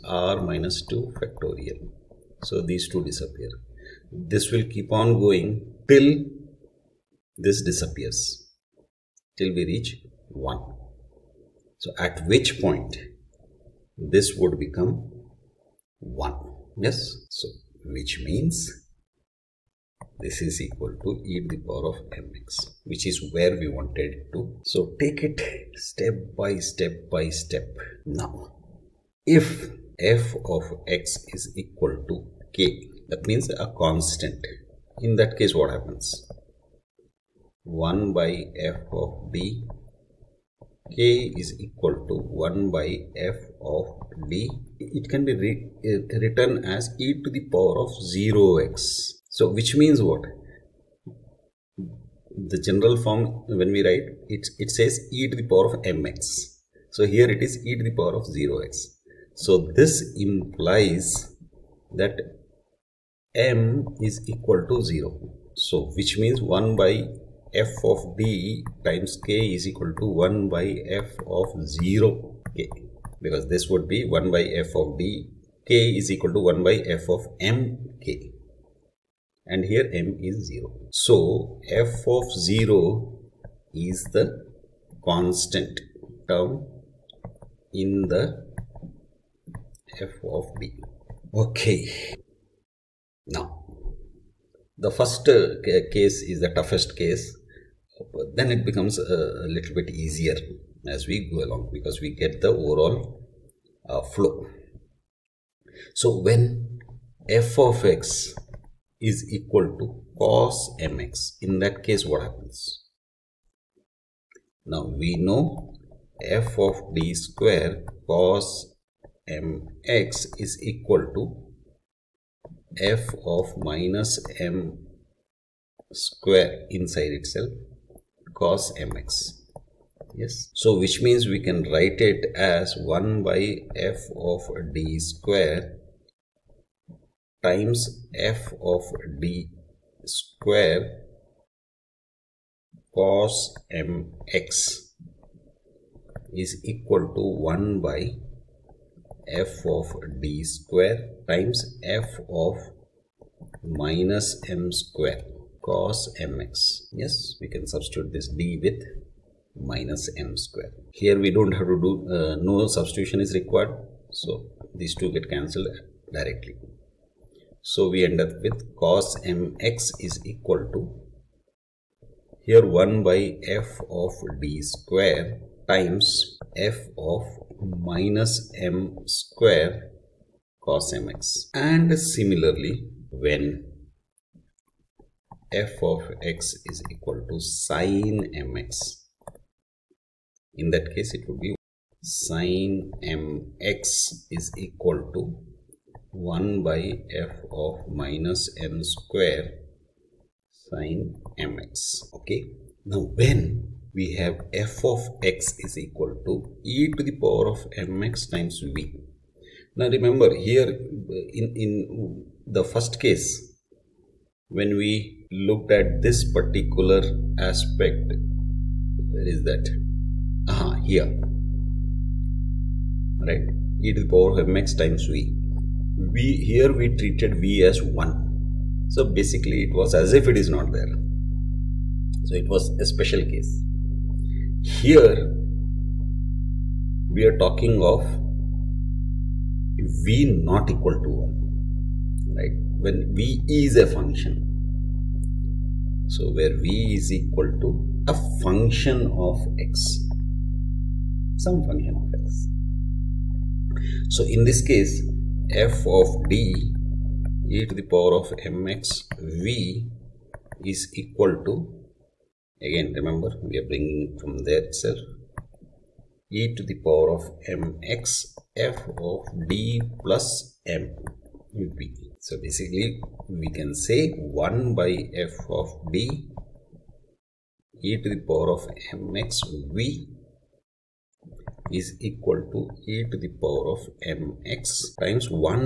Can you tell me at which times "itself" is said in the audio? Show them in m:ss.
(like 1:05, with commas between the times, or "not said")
2:07, 4:24.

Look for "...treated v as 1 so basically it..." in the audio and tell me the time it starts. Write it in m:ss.
3:46.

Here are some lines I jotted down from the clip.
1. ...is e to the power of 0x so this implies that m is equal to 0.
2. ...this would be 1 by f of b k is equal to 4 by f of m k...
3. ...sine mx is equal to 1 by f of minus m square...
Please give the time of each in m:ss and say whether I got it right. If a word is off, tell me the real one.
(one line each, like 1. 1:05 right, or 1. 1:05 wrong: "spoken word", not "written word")
1. 0:57 right
2. 1:13 wrong: "1", not "4"
3. 3:12 right.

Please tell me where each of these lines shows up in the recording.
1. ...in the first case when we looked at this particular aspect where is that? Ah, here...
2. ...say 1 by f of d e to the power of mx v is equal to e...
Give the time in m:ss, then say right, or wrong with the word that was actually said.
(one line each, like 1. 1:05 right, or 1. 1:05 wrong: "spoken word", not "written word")
1. 3:31 right
2. 4:33 right.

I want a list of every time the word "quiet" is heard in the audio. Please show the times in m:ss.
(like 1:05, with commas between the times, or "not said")
not said.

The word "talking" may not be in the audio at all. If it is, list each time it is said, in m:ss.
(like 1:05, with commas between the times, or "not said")
3:57.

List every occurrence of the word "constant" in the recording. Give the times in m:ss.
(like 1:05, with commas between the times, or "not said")
0:33, 1:25.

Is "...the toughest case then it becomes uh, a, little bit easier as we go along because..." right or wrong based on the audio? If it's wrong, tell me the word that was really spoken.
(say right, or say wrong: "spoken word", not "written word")
right.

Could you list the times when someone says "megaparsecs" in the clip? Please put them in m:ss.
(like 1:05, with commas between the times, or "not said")
not said.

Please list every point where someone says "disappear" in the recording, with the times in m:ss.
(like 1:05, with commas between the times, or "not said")
0:03, 0:07.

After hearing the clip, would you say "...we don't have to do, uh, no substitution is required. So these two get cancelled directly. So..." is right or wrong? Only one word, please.
right.